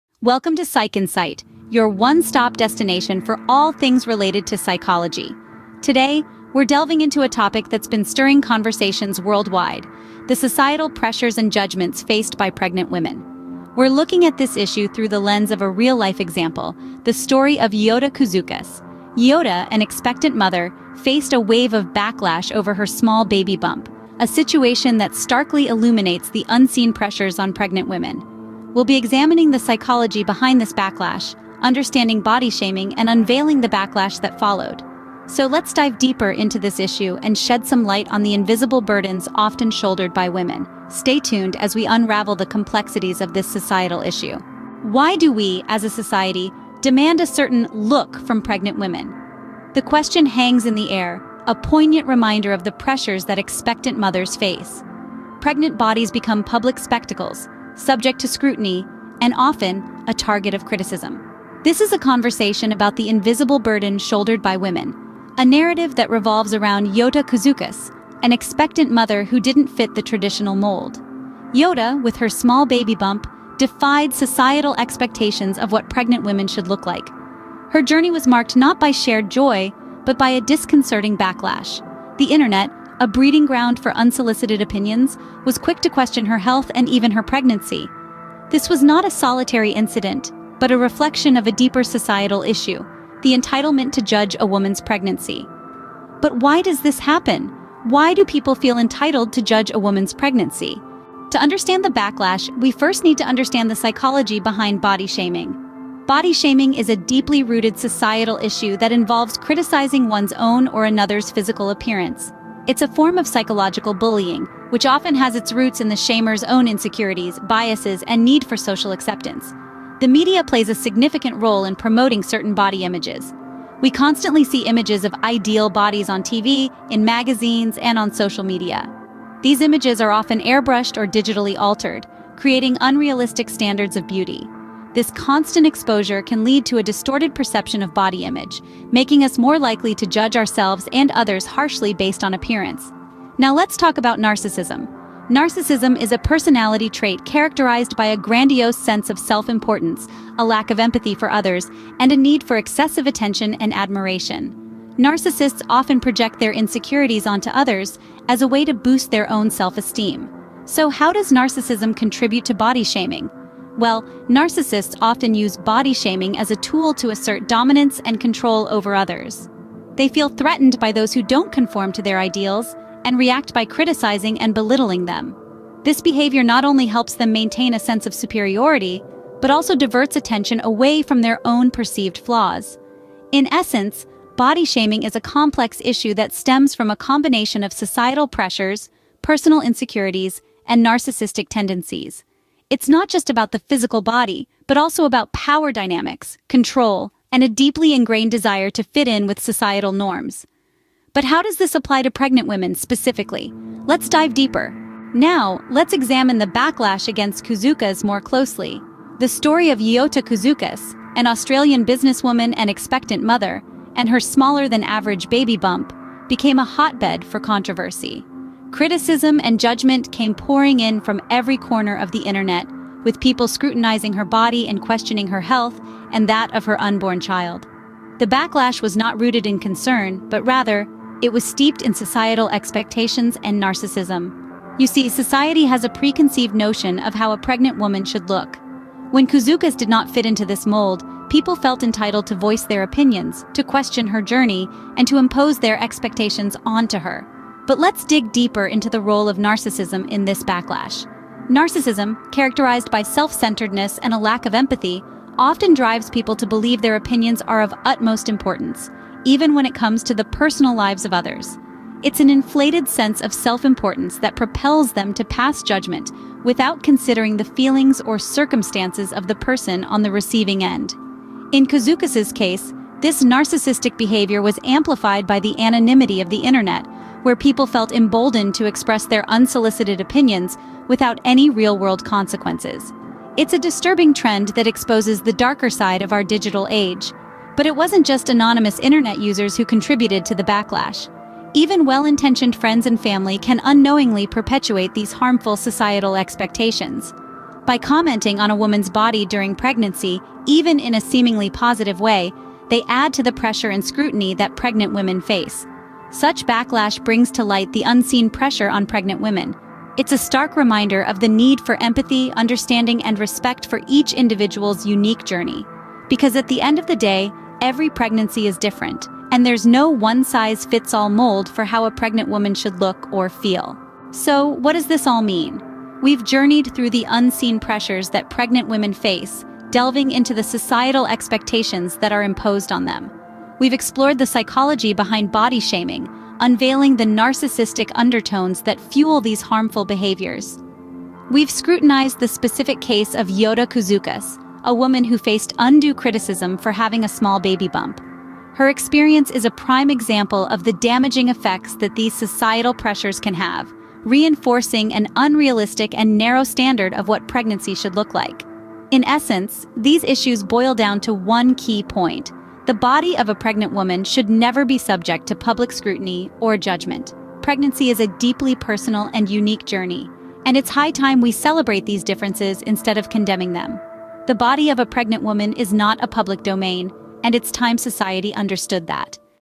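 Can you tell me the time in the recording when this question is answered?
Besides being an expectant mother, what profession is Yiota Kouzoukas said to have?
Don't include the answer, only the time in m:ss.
3:31.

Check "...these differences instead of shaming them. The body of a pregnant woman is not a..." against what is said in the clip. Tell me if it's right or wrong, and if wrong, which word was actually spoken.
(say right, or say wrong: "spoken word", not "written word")
wrong: "condemning", not "shaming".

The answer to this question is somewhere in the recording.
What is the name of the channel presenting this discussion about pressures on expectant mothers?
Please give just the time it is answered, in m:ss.
0:00.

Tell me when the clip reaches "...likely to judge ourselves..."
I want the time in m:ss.
2:19.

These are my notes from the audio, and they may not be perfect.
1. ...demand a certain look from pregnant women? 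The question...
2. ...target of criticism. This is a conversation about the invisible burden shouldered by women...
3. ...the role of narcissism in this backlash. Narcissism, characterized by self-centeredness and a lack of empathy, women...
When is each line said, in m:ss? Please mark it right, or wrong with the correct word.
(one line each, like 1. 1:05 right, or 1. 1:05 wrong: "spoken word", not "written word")
1. 0:46 right
2. 1:00 right
3. 4:08 wrong: "often", not "women".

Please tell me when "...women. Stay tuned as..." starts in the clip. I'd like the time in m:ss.
0:40.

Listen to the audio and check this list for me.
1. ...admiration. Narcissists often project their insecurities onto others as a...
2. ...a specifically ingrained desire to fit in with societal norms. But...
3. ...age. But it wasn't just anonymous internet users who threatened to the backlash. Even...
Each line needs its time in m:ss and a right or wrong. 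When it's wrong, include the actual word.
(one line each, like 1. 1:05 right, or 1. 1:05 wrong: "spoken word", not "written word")
1. 2:33 right
2. 3:17 wrong: "deeply", not "specifically"
3. 4:46 wrong: "contributed", not "threatened".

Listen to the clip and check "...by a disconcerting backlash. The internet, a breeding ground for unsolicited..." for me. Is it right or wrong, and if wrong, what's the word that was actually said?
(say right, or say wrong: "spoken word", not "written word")
right.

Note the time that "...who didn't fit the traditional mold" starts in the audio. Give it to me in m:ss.
1:09.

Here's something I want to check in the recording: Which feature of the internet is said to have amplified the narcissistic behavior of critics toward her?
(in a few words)
Anonymity.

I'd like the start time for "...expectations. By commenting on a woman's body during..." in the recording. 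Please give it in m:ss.
4:56.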